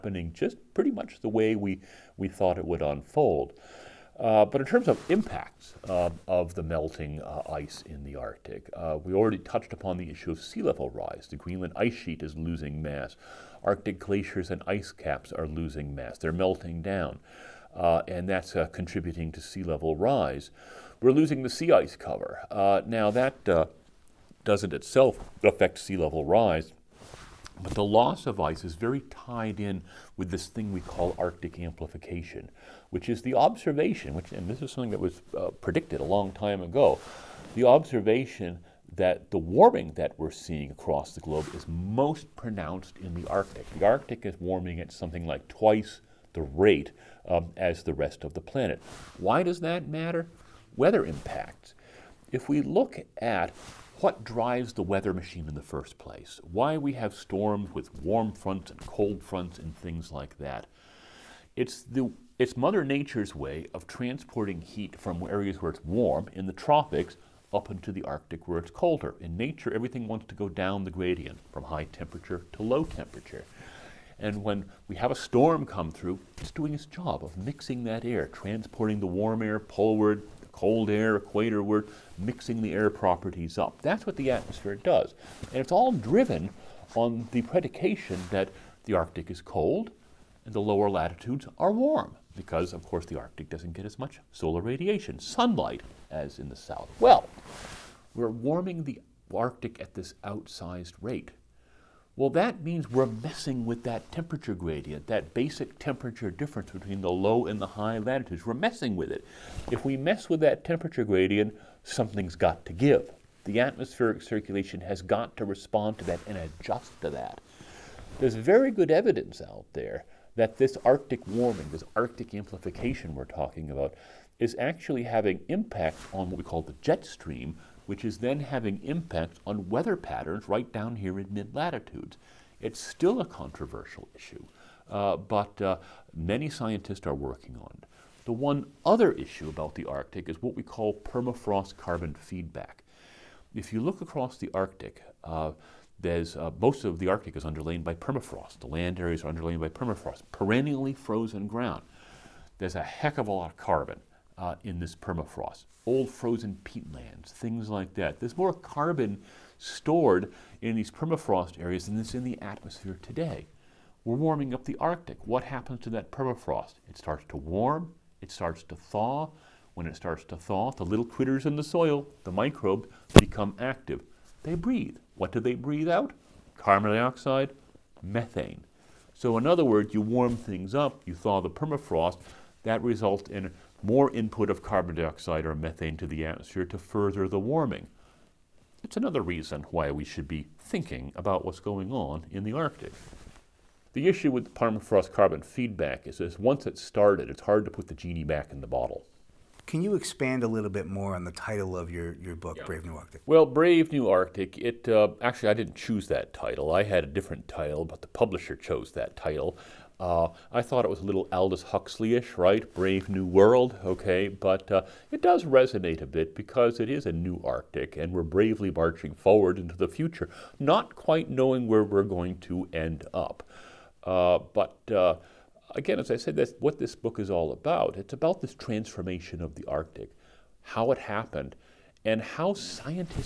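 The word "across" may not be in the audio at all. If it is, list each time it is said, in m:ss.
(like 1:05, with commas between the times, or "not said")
0:40, 2:24.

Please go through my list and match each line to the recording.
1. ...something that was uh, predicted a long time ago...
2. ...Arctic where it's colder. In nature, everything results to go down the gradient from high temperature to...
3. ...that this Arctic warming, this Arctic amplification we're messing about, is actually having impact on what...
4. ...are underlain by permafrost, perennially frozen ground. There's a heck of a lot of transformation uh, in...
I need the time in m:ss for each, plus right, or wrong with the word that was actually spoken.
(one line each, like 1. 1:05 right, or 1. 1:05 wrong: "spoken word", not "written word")
1. 0:34 right
2. 1:08 wrong: "wants", not "results"
3. 2:00 wrong: "talking", not "messing"
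4. 2:29 wrong: "carbon", not "transformation".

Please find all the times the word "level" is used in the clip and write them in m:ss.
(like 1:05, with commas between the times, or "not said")
0:10, 0:19, 0:25.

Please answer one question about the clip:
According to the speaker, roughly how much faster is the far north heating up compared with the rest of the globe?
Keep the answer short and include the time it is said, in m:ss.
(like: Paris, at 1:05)
twice the rate, at 0:45.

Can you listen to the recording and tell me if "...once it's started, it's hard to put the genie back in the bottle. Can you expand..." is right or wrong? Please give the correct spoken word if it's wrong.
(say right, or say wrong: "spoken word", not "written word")
right.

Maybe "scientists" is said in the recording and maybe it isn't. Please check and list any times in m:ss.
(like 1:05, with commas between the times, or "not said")
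2:16, 3:52.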